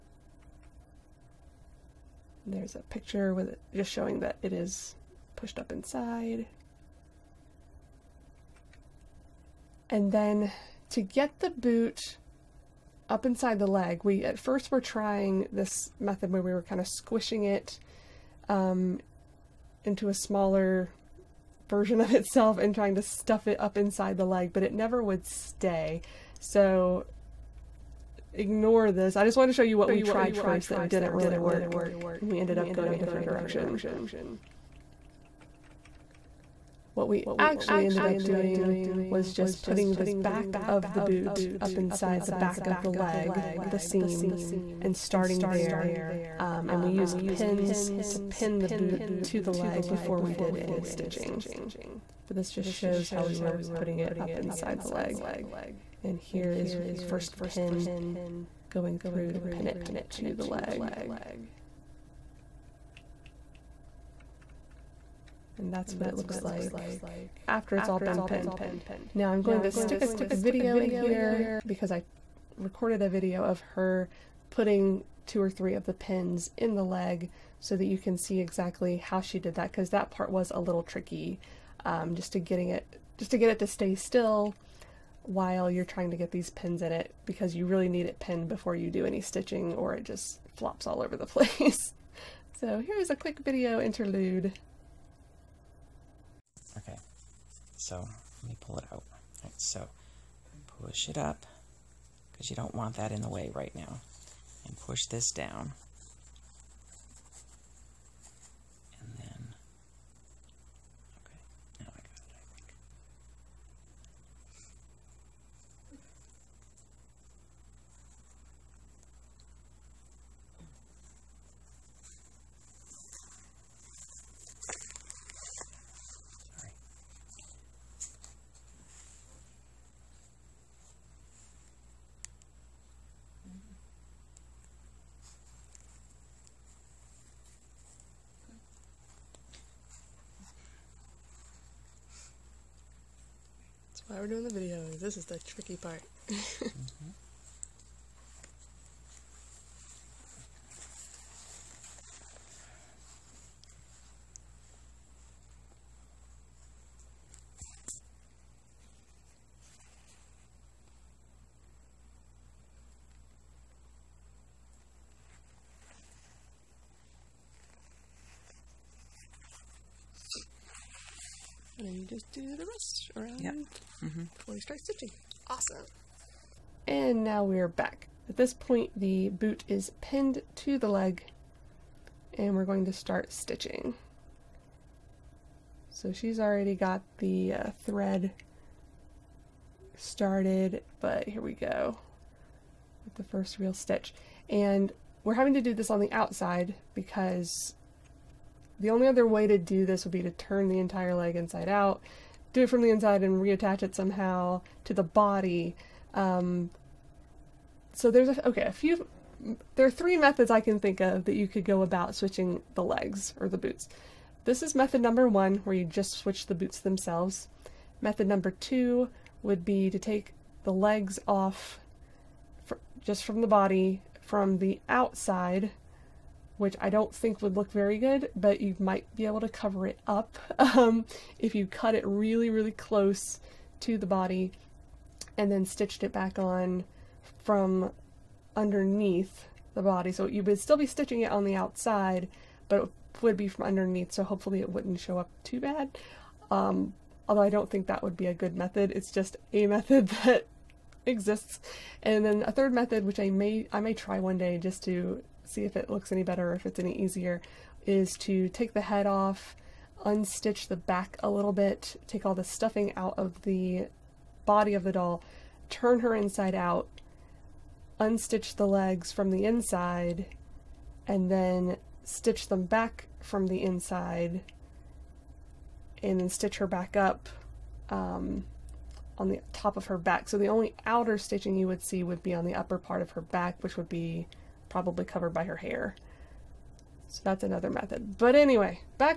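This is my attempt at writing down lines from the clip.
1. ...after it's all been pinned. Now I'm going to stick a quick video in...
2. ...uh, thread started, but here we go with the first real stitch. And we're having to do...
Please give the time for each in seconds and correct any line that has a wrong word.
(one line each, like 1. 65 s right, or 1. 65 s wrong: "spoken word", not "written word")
1. 67 s right
2. 187 s right.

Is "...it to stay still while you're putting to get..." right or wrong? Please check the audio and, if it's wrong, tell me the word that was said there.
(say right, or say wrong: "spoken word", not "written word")
wrong: "trying", not "putting".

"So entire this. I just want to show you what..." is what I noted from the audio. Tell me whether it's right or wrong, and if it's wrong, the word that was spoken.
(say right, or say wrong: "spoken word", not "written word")
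wrong: "ignore", not "entire".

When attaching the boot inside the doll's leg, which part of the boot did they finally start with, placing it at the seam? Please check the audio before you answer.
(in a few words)
The back of the boot.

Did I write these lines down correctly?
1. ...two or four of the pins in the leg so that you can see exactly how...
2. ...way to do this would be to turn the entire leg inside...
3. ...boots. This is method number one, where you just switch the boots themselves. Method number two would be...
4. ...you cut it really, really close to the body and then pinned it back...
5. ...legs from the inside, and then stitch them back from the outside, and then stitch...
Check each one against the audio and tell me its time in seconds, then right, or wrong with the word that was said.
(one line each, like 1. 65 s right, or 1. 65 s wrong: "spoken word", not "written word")
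1. 75 s wrong: "three", not "four"
2. 199 s right
3. 213 s right
4. 231 s wrong: "stitched", not "pinned"
5. 268 s wrong: "inside", not "outside".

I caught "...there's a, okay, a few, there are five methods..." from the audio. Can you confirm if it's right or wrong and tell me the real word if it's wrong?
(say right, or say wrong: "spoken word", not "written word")
wrong: "three", not "five".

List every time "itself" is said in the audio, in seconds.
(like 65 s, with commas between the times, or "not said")
22 s.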